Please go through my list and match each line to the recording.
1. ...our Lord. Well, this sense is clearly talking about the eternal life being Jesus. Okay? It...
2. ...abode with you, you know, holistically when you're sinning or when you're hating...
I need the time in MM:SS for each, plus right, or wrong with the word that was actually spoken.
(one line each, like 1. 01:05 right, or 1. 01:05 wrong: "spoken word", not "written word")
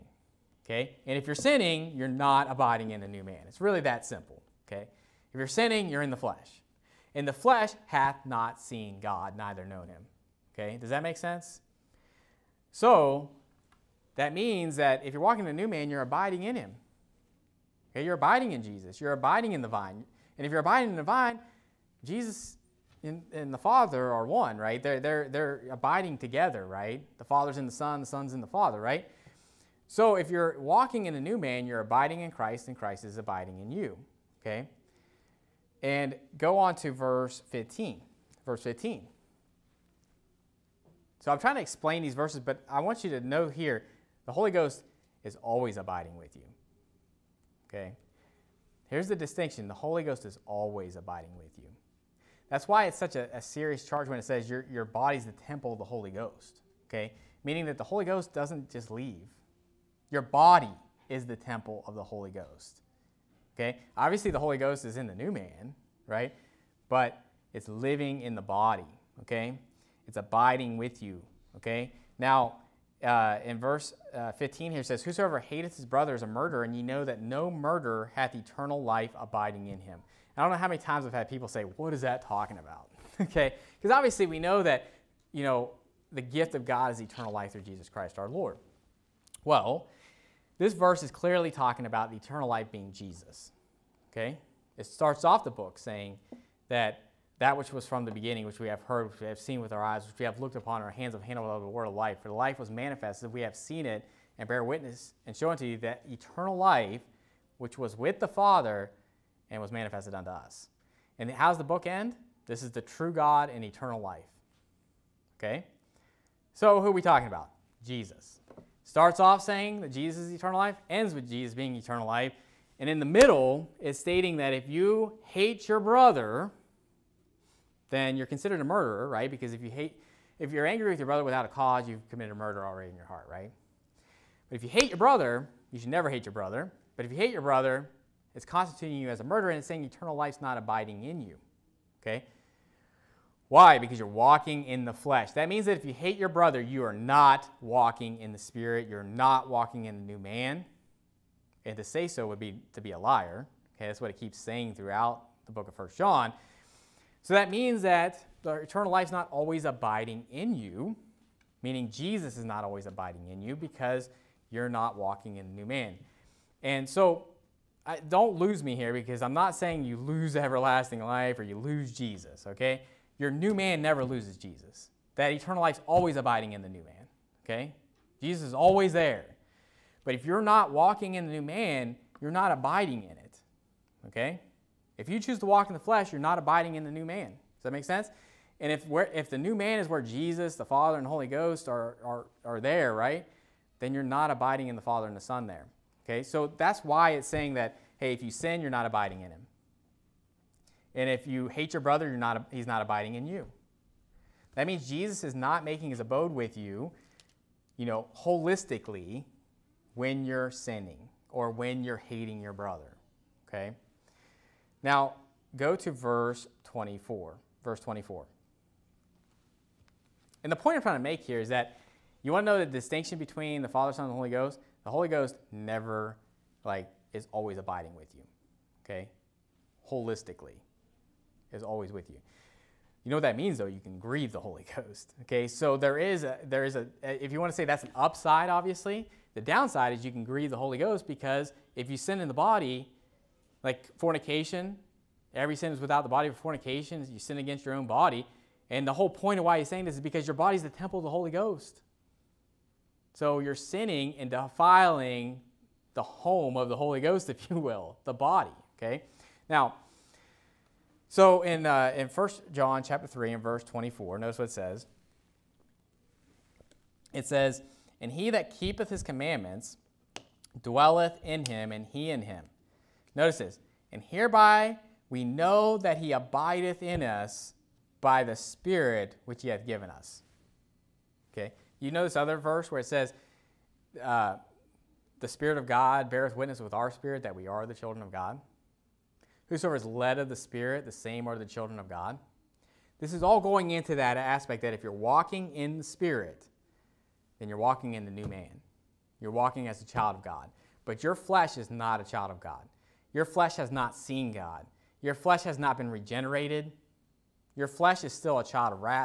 1. 01:28 wrong: "verse", not "sense"
2. 03:26 right.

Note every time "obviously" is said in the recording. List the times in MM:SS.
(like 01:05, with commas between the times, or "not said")
01:03, 01:23, 03:58.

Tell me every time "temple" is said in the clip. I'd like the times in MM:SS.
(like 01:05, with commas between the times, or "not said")
00:55, 01:01, 04:10.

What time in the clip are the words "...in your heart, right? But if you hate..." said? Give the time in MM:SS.
02:12.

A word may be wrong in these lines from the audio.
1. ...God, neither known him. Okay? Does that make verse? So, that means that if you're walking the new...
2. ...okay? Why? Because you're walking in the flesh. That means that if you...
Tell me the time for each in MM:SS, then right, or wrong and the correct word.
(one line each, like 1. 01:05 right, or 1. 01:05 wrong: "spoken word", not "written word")
1. 00:09 wrong: "sense", not "verse"
2. 02:22 right.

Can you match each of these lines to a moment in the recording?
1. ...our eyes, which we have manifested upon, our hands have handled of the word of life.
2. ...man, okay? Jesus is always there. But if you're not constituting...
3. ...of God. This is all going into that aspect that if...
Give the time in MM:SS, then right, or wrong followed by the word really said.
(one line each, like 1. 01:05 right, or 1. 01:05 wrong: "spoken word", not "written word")
1. 01:39 wrong: "looked", not "manifested"
2. 02:56 wrong: "walking", not "constituting"
3. 04:51 right.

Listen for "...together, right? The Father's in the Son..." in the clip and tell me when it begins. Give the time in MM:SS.
00:26.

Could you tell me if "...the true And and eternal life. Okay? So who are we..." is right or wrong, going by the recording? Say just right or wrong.
wrong.